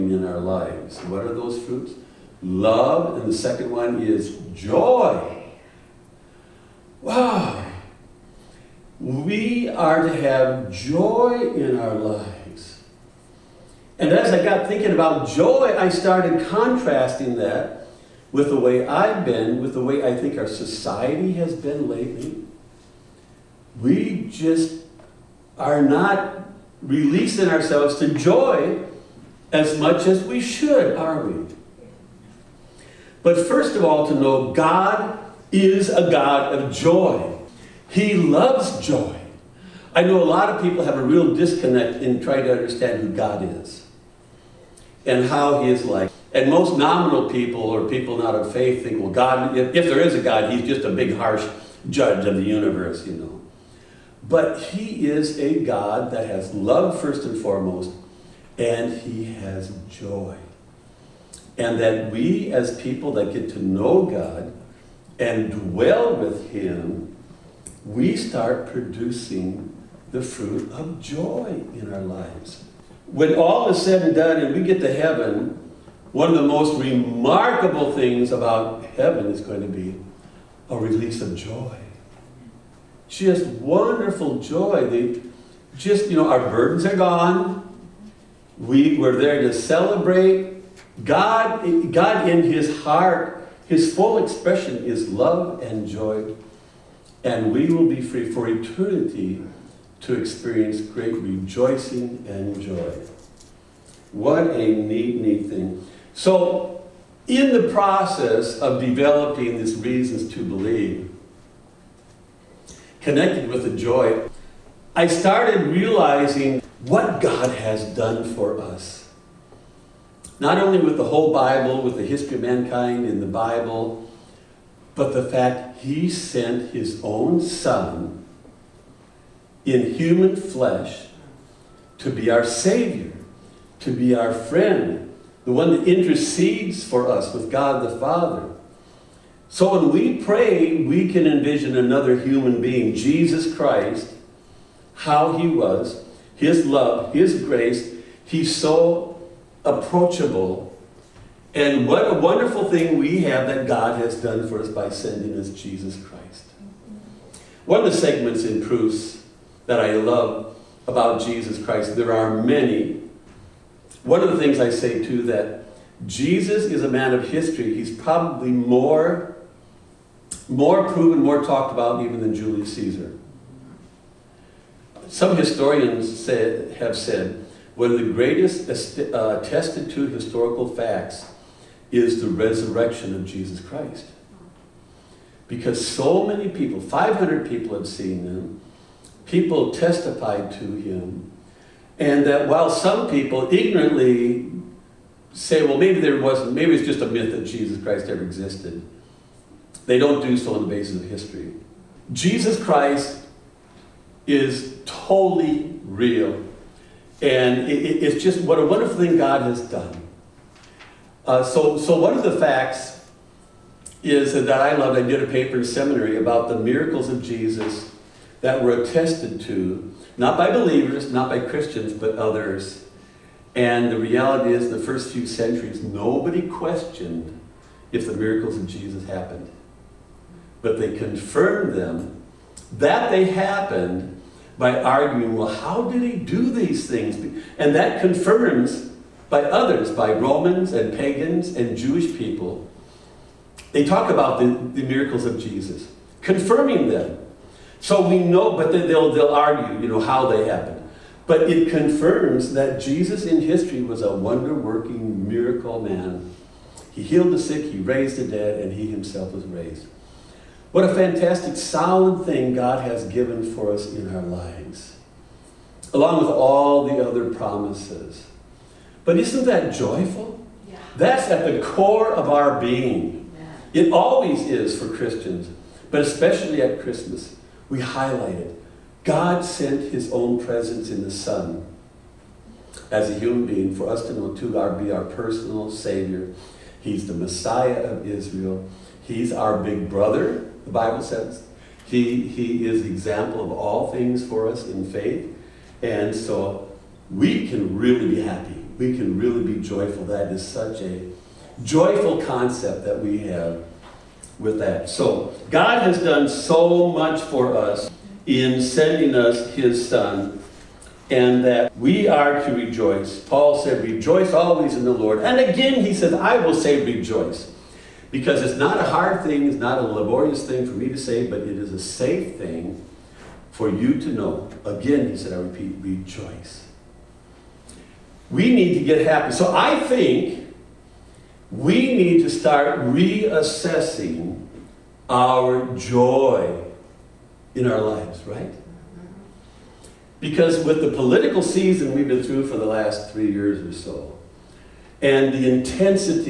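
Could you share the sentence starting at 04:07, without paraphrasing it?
So we know, but then they'll, they'll argue, you know, how they happened.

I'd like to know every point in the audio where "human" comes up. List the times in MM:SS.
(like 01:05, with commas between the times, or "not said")
02:09, 02:22, 04:43.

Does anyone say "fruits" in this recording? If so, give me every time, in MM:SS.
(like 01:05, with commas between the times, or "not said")
00:01, 01:10.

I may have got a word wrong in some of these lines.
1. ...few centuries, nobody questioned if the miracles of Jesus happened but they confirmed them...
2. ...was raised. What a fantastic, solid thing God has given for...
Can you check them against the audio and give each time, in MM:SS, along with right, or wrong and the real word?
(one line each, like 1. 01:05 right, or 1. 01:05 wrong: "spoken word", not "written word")
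1. 03:45 right
2. 04:19 right.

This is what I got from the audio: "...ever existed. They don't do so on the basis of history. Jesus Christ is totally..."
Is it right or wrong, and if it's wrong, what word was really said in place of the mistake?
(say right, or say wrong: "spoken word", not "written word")
right.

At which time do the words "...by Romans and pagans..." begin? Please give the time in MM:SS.
03:59.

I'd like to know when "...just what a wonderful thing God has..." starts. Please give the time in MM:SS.
03:28.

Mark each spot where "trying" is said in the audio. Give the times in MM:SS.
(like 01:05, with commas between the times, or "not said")
00:42.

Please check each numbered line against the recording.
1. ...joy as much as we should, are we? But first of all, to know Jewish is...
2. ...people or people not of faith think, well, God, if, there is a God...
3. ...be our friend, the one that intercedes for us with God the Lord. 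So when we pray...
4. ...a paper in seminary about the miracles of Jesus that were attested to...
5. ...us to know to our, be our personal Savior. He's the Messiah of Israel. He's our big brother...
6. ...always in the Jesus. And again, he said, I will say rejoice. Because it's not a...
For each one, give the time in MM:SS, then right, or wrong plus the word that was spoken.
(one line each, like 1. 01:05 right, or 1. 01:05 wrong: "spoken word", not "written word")
1. 00:28 wrong: "God", not "Jewish"
2. 00:47 right
3. 02:13 wrong: "Father", not "Lord"
4. 03:35 right
5. 04:43 right
6. 05:14 wrong: "Lord", not "Jesus".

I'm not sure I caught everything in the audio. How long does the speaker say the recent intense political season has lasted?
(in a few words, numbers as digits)
Three years.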